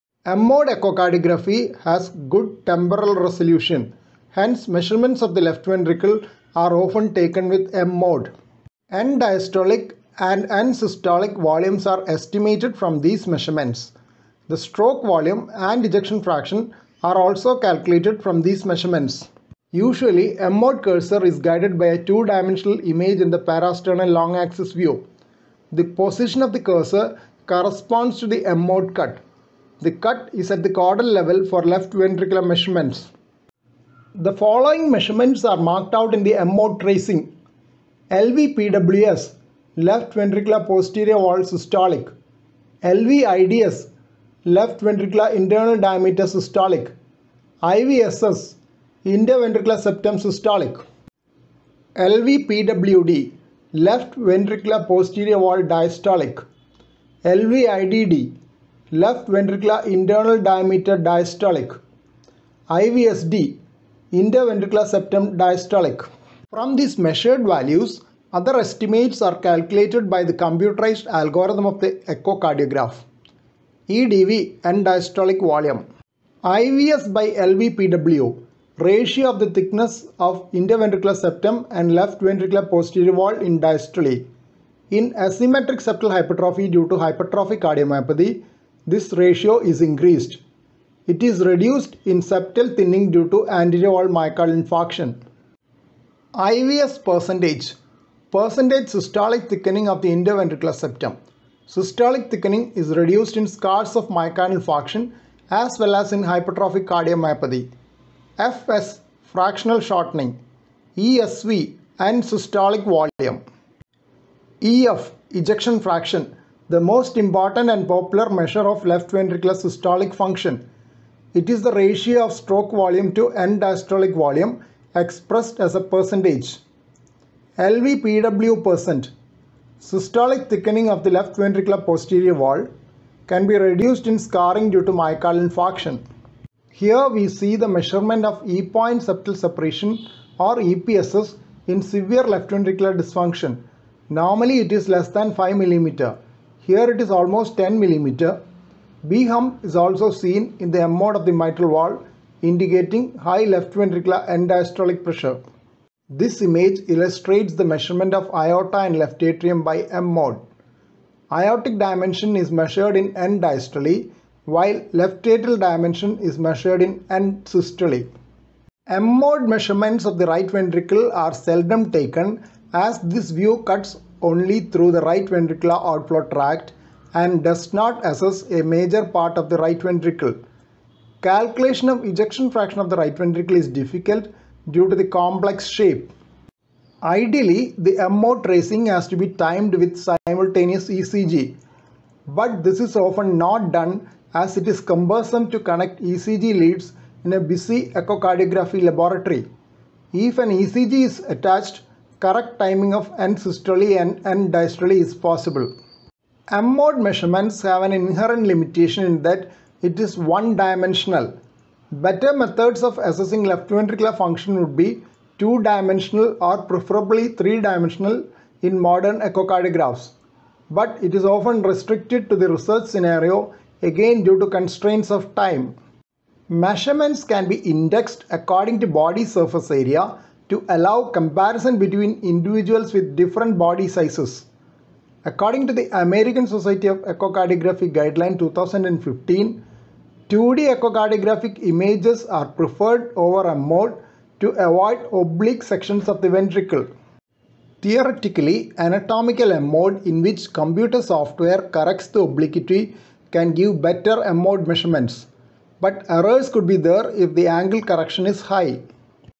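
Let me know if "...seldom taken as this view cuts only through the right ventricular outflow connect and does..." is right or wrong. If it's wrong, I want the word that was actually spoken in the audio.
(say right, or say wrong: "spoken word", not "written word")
wrong: "tract", not "connect".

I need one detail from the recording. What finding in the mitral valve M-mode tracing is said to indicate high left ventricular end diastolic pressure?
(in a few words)
B-hump.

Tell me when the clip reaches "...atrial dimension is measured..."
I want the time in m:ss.
2:45.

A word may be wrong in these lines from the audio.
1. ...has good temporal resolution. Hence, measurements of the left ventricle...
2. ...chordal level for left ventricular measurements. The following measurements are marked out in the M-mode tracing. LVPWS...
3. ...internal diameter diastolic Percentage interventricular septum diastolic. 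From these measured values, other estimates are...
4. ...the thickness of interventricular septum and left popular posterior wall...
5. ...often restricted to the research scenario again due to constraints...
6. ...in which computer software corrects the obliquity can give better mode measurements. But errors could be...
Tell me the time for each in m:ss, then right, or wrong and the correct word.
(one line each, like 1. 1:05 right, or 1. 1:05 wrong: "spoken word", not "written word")
1. 0:01 right
2. 0:30 right
3. 0:59 wrong: "IVSD", not "Percentage"
4. 1:19 wrong: "ventricular", not "popular"
5. 3:41 right
6. 4:10 right.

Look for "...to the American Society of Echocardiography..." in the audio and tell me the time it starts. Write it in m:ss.
3:55.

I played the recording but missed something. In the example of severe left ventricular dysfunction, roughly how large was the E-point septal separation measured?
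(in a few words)
10 mm.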